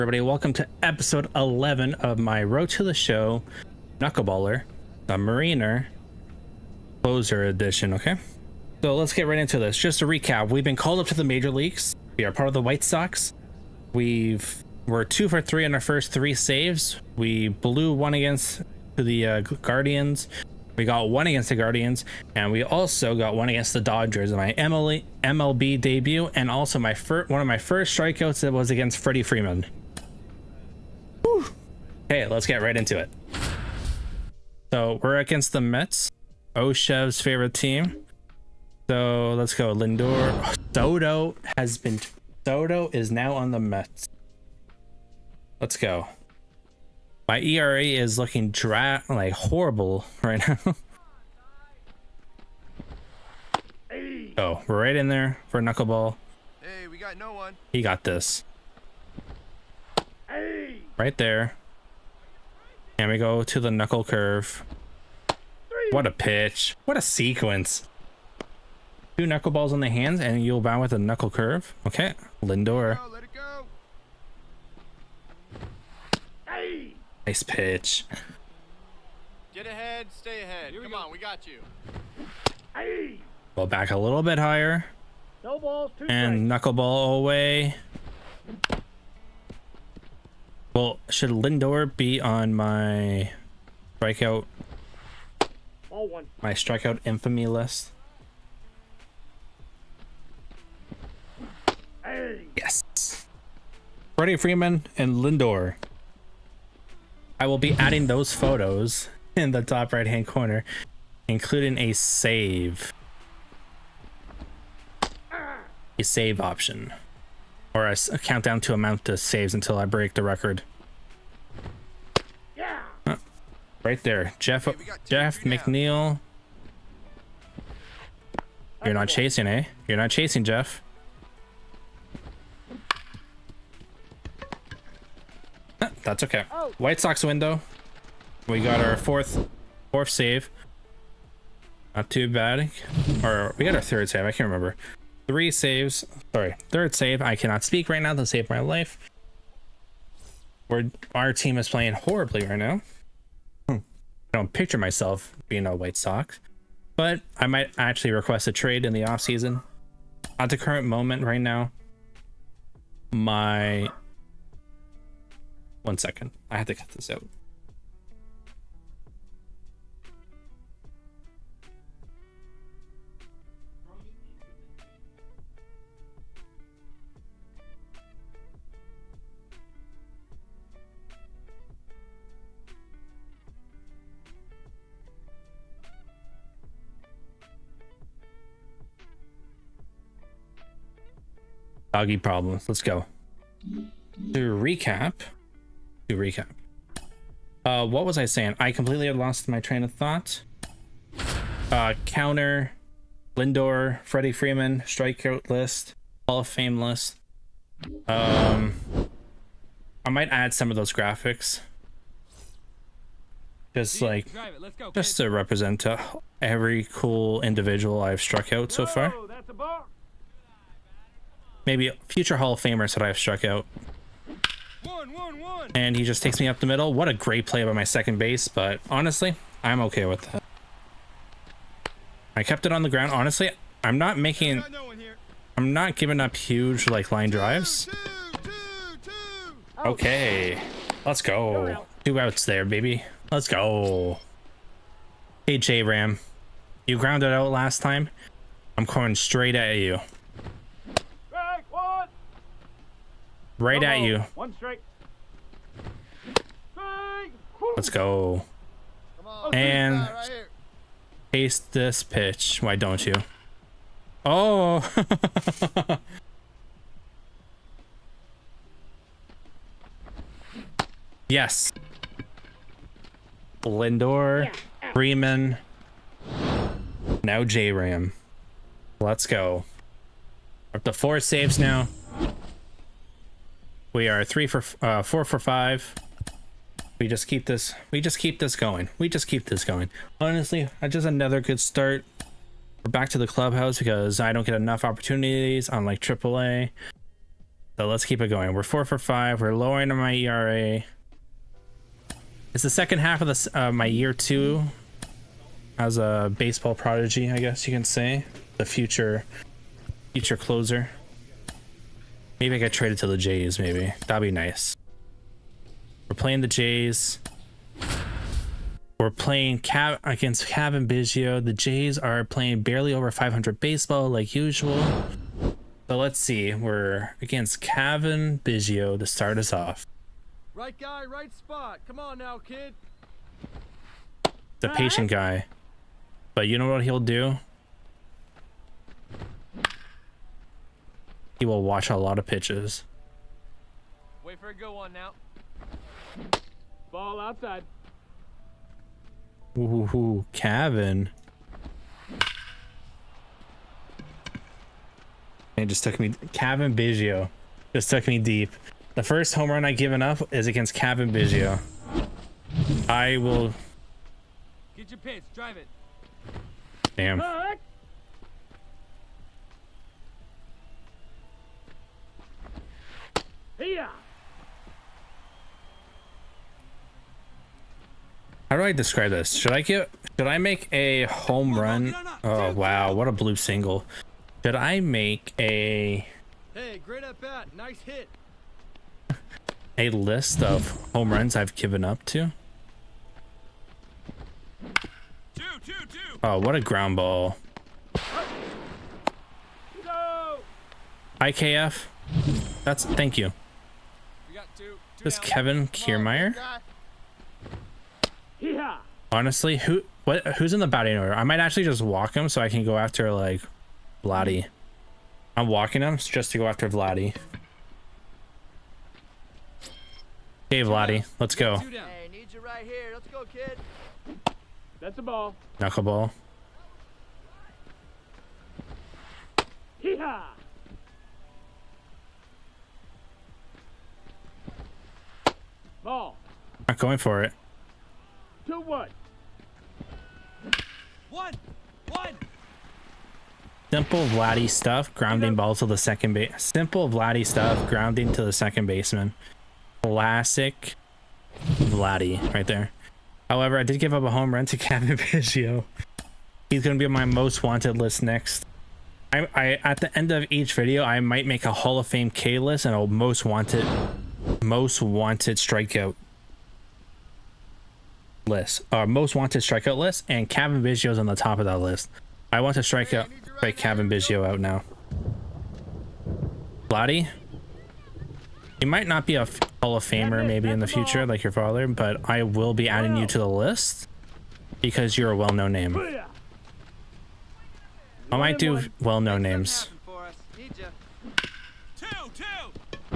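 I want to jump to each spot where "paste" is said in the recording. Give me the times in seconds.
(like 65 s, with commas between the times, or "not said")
261 s.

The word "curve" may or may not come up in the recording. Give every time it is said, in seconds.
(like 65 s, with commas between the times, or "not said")
64 s, 71 s.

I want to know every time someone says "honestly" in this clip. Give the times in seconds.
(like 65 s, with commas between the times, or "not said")
228 s, 233 s, 290 s, 409 s.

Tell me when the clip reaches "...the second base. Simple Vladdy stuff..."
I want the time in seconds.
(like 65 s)
445 s.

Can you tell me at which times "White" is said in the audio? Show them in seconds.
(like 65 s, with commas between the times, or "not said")
12 s, 136 s, 155 s.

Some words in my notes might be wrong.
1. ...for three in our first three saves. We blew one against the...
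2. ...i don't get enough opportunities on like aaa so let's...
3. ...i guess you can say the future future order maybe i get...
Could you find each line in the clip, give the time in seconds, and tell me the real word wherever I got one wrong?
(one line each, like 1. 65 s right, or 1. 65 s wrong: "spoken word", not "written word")
1. 15 s right
2. 294 s right
3. 307 s wrong: "closer", not "order".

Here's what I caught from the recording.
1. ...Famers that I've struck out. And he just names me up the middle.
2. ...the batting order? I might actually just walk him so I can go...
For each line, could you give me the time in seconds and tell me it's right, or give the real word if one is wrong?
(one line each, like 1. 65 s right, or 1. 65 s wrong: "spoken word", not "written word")
1. 222 s wrong: "takes", not "names"
2. 410 s right.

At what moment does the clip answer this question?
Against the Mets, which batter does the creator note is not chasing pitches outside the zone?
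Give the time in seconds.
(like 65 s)
125 s.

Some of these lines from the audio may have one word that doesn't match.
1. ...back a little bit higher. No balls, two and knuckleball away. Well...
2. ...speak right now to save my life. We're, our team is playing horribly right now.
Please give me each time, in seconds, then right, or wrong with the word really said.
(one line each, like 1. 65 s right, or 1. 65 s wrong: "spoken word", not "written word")
1. 83 s right
2. 147 s right.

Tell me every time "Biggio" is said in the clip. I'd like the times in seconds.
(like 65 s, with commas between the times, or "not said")
320 s, 328 s, 356 s, 361 s, 454 s, 473 s.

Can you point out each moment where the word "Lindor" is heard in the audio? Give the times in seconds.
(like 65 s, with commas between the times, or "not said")
39 s, 72 s, 91 s, 105 s, 203 s, 273 s.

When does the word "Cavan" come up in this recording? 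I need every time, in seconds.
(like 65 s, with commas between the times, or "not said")
320 s, 327 s, 350 s.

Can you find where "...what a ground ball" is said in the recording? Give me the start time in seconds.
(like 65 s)
396 s.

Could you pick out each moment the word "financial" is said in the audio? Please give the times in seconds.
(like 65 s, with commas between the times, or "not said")
not said.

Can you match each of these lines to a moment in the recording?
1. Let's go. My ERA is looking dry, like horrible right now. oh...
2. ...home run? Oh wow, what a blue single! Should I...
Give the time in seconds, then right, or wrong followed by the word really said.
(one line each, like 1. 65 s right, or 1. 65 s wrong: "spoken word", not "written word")
1. 45 s right
2. 381 s right.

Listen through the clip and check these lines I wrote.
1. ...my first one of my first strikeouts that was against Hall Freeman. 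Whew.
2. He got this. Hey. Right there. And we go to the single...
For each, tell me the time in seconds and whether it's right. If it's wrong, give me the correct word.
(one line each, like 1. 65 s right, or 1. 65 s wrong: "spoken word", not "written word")
1. 26 s wrong: "Freddie", not "Hall"
2. 57 s wrong: "knuckle", not "single".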